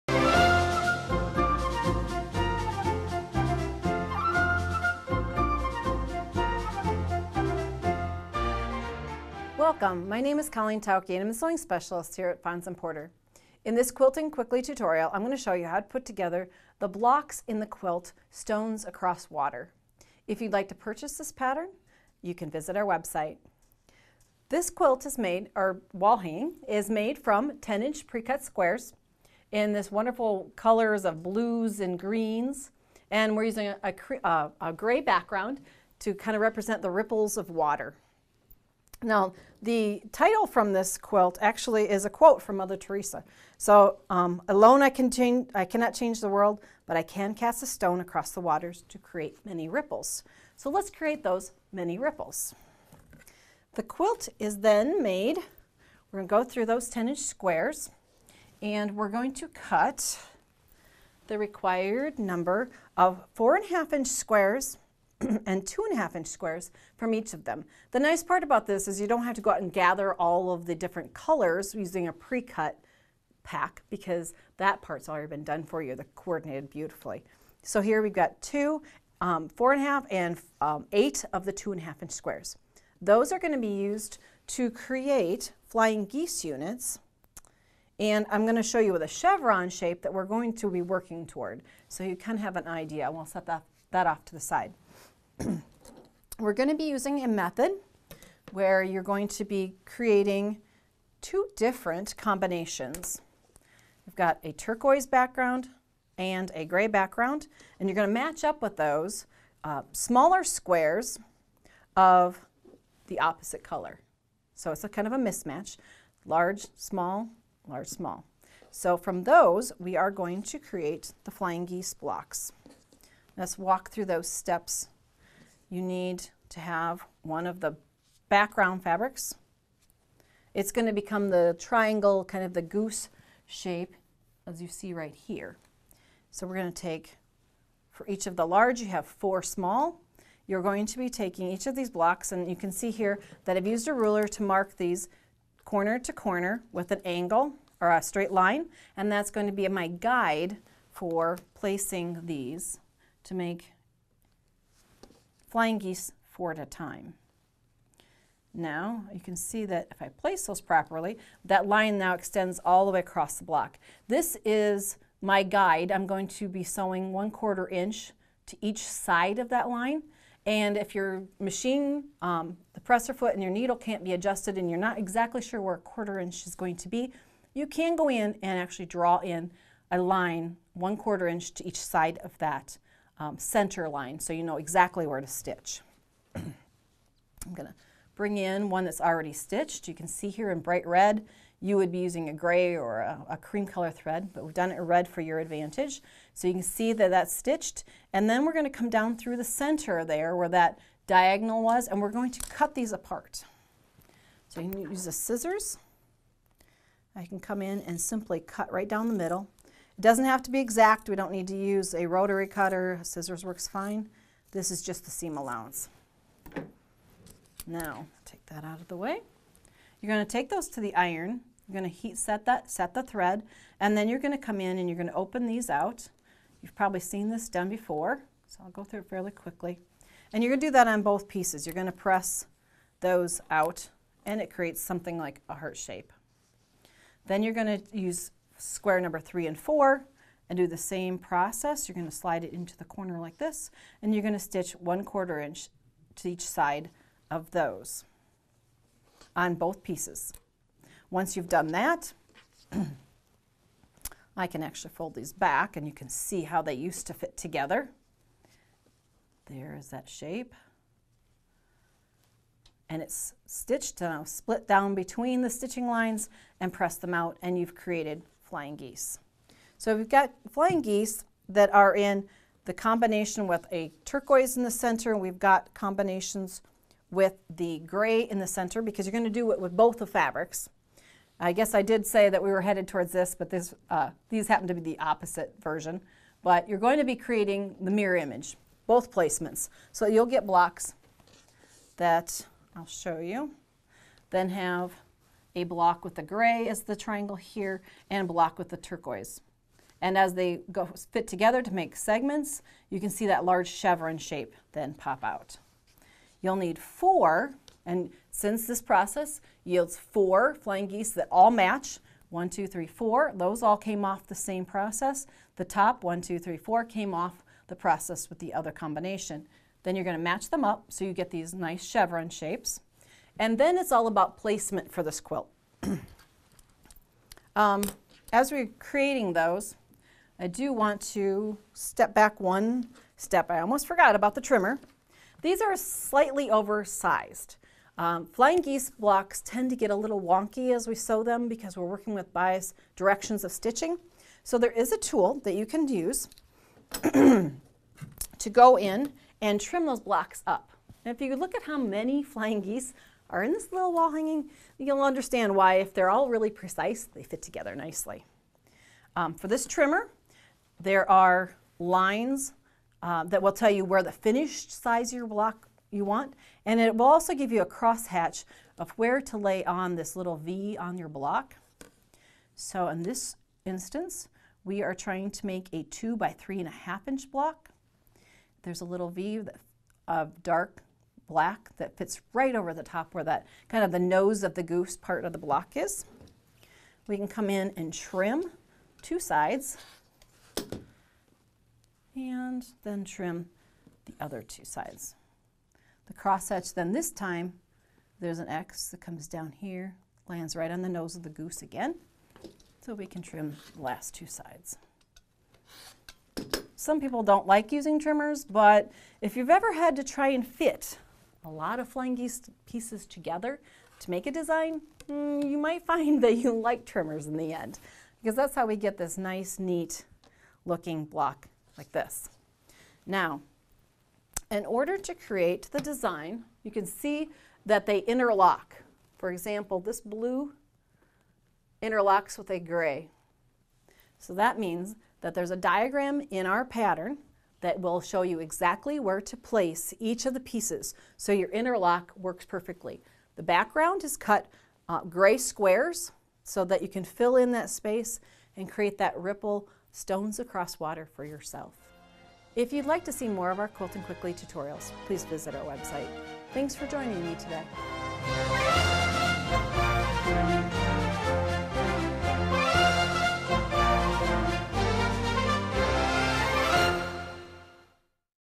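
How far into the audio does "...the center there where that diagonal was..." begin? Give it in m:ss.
3:19.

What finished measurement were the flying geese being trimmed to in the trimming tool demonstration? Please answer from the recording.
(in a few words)
2 by 3 1/2 inches.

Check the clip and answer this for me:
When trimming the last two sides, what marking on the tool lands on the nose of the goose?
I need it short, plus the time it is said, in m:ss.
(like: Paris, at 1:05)
An X, at 6:38.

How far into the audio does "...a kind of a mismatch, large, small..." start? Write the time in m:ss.
1:54.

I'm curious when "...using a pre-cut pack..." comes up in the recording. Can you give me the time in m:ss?
1:11.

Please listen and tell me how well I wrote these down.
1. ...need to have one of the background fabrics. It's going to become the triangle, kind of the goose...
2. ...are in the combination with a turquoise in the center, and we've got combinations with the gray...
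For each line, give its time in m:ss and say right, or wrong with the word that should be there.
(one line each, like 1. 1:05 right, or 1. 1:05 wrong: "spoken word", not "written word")
1. 2:05 right
2. 4:31 right.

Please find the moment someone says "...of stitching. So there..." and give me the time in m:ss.
5:43.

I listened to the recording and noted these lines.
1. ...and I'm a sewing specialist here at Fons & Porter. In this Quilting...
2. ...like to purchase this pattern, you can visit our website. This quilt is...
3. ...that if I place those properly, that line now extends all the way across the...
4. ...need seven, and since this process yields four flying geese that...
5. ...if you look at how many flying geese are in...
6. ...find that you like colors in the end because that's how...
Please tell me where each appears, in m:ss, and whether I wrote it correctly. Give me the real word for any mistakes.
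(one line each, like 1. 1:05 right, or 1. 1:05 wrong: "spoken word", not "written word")
1. 0:11 right
2. 0:20 right
3. 2:39 right
4. 5:06 wrong: "four", not "seven"
5. 5:51 right
6. 6:55 wrong: "trimmers", not "colors".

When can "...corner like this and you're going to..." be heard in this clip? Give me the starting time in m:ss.
4:02.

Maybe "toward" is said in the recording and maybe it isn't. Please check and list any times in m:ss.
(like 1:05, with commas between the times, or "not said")
1:31, 4:42.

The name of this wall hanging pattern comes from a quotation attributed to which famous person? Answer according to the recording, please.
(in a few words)
Mother Teresa.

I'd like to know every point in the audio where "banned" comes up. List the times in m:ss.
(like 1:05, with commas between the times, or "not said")
not said.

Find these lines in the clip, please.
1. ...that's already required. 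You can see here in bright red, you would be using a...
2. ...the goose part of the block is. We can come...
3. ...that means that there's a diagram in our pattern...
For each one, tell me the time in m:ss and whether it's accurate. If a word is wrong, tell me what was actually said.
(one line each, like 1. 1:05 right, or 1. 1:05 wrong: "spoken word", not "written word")
1. 3:08 wrong: "stitched", not "required"
2. 6:24 right
3. 7:14 right.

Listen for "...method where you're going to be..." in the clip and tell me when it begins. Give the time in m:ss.
1:37.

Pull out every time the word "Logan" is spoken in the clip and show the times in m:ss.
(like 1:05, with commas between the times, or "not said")
not said.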